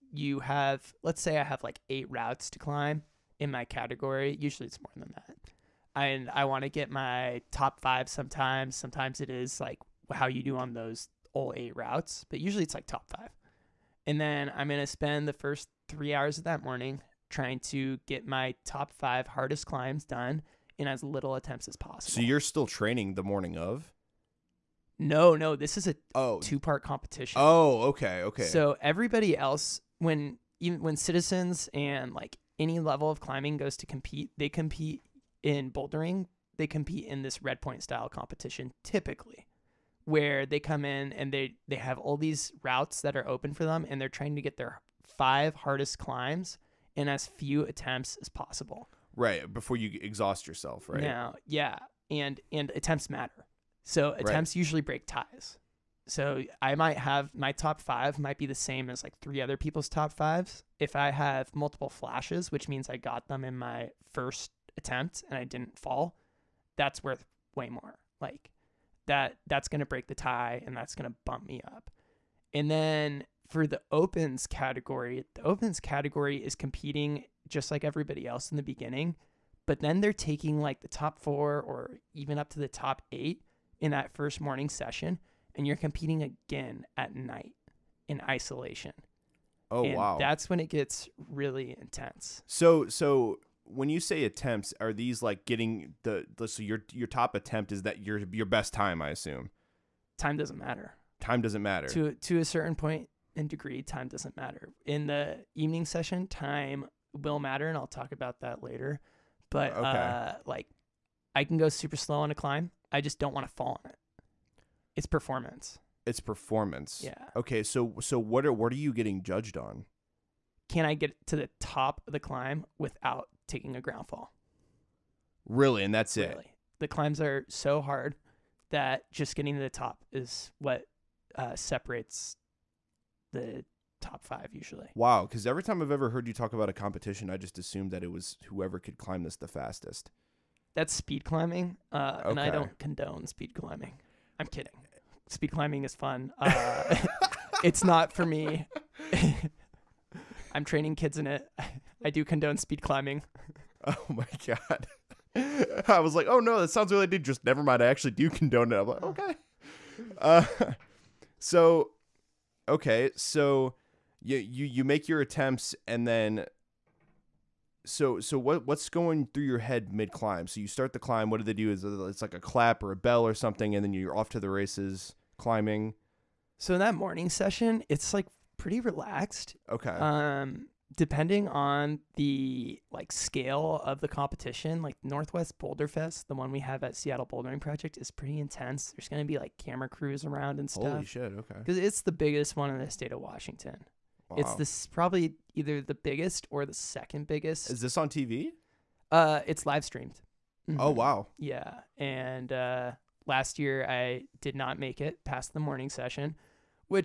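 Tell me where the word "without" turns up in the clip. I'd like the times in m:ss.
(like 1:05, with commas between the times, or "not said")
2:02.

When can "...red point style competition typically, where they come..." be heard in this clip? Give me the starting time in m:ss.
0:37.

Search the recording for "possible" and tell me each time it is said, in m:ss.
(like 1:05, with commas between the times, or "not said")
0:21, 0:48.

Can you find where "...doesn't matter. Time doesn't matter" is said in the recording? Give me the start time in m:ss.
1:40.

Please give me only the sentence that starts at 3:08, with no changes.
There's going to be like camera crews around and stuff.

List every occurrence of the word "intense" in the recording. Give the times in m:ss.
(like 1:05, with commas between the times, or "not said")
1:31, 3:08.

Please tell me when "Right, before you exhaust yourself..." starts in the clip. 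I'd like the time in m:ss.
0:49.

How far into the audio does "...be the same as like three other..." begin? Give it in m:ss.
0:58.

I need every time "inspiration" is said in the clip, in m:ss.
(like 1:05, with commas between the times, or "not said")
not said.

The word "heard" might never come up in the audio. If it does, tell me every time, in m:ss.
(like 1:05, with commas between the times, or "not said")
2:16.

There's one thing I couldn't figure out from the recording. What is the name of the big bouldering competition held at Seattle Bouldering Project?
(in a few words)
Northwest Boulderfest.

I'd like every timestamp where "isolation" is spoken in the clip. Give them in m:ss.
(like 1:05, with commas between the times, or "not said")
1:28.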